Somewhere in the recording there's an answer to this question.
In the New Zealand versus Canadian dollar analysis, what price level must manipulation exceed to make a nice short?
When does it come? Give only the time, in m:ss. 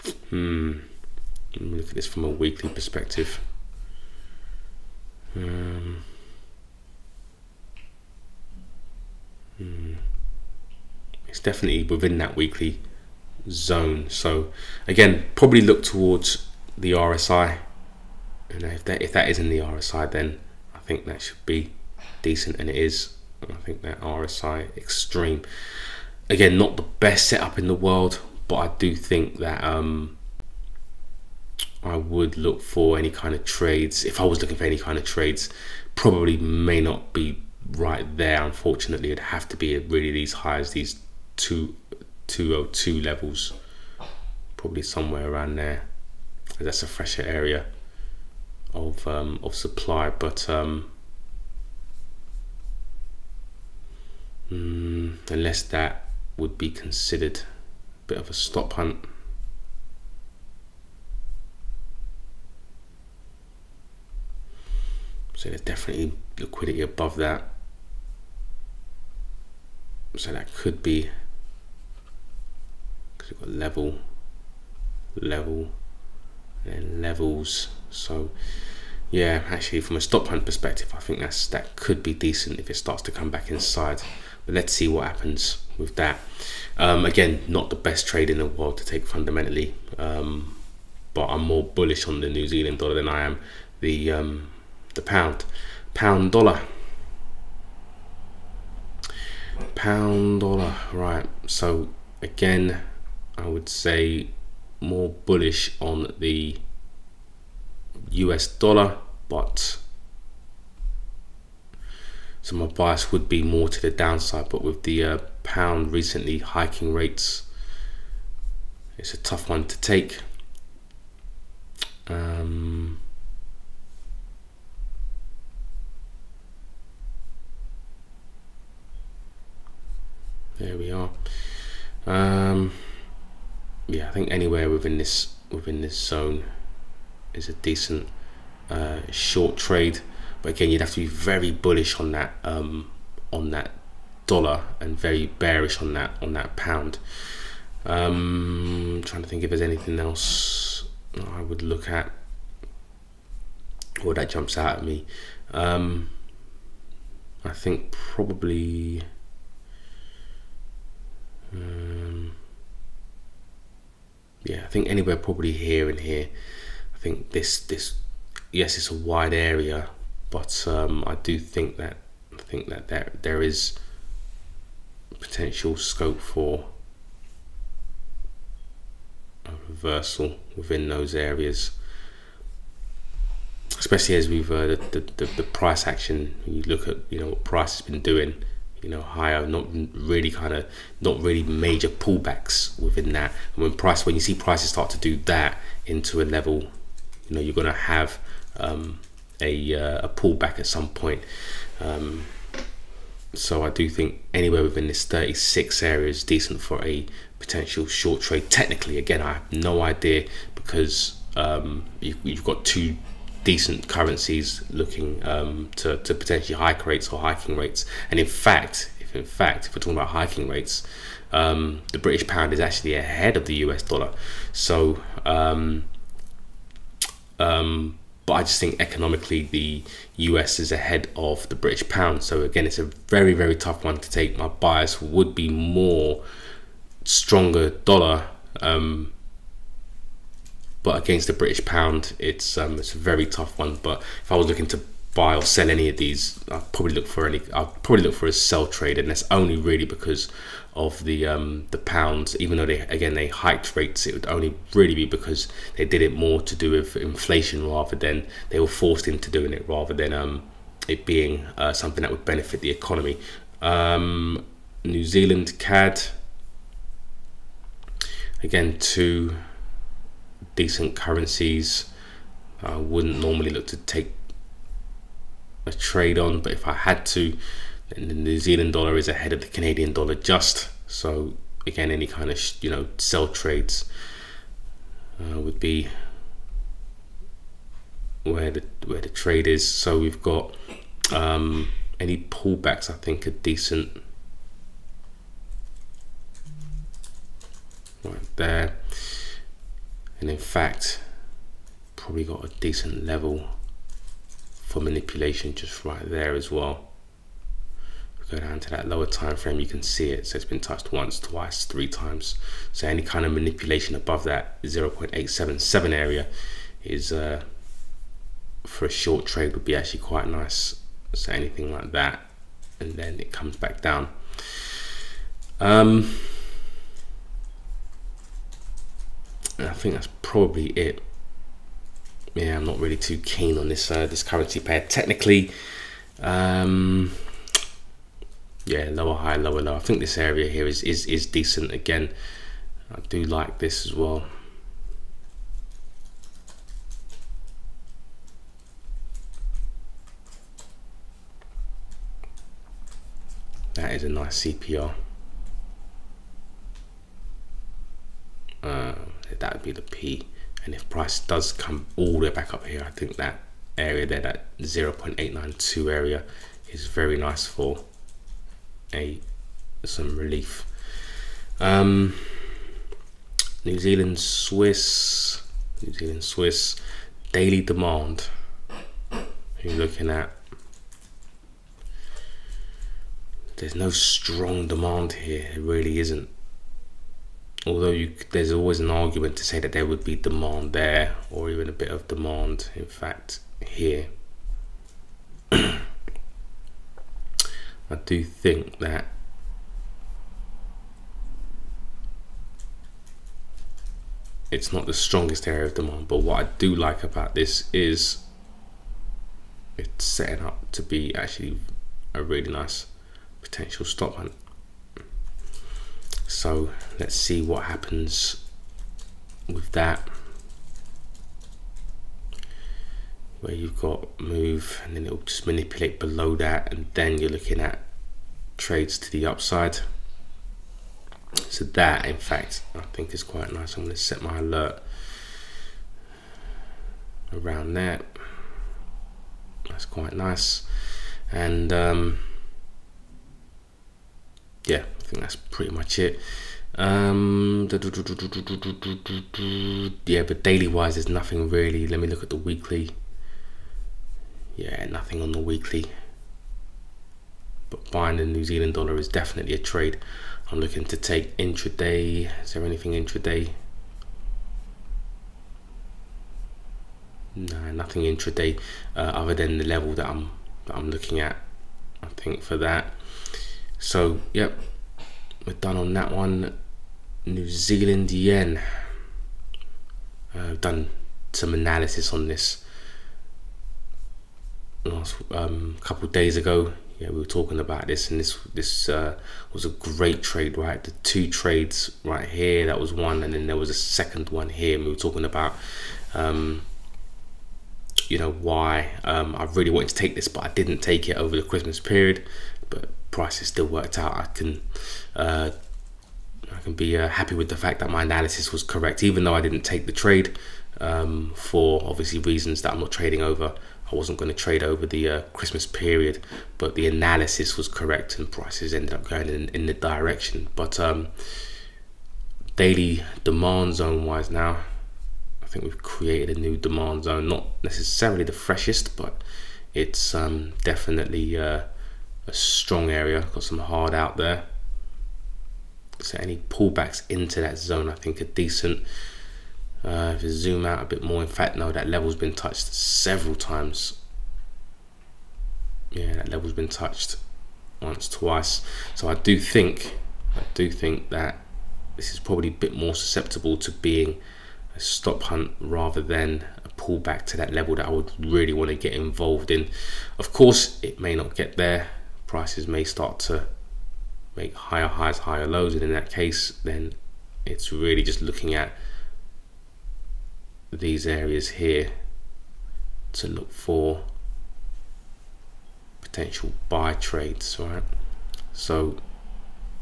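5:14.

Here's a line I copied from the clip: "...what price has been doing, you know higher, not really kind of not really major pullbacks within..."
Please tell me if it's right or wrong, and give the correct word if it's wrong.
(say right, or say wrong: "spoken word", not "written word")
right.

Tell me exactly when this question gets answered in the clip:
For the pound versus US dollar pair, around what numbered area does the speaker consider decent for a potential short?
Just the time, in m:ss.
3:25.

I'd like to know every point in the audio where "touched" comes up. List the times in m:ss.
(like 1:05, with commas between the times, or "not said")
5:10, 9:02, 9:06.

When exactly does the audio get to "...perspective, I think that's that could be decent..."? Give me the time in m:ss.
1:20.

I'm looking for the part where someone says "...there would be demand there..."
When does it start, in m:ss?
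6:29.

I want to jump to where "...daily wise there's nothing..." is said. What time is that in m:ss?
7:30.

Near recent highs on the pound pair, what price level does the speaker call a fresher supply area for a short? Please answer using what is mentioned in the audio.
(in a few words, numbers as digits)
202.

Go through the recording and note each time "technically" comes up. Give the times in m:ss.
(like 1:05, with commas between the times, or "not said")
3:28, 5:34.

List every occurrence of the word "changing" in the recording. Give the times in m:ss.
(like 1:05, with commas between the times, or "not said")
not said.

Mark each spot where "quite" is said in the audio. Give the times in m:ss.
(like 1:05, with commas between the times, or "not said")
5:19, 7:13, 7:19.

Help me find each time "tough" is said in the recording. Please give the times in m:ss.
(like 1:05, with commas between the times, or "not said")
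1:59, 3:53, 4:03.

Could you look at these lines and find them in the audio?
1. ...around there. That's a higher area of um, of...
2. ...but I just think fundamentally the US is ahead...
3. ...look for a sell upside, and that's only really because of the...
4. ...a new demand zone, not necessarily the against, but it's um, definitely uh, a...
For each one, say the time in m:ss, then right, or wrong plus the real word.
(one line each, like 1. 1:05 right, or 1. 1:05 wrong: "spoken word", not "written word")
1. 0:45 wrong: "fresher", not "higher"
2. 3:48 wrong: "economically", not "fundamentally"
3. 4:08 wrong: "trade", not "upside"
4. 8:46 wrong: "freshest", not "against".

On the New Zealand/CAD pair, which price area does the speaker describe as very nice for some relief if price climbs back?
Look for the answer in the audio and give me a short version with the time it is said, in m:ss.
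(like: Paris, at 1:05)
0.892, at 6:04.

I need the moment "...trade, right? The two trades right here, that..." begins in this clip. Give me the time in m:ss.
8:10.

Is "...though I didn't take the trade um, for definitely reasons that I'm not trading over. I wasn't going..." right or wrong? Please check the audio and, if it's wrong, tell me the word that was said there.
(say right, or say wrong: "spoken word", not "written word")
wrong: "obviously", not "definitely".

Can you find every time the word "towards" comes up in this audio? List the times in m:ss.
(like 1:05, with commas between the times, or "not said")
0:15.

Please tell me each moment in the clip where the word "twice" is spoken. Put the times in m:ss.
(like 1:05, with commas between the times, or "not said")
5:11, 9:08.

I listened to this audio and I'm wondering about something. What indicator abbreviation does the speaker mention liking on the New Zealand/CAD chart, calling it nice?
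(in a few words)
CPR.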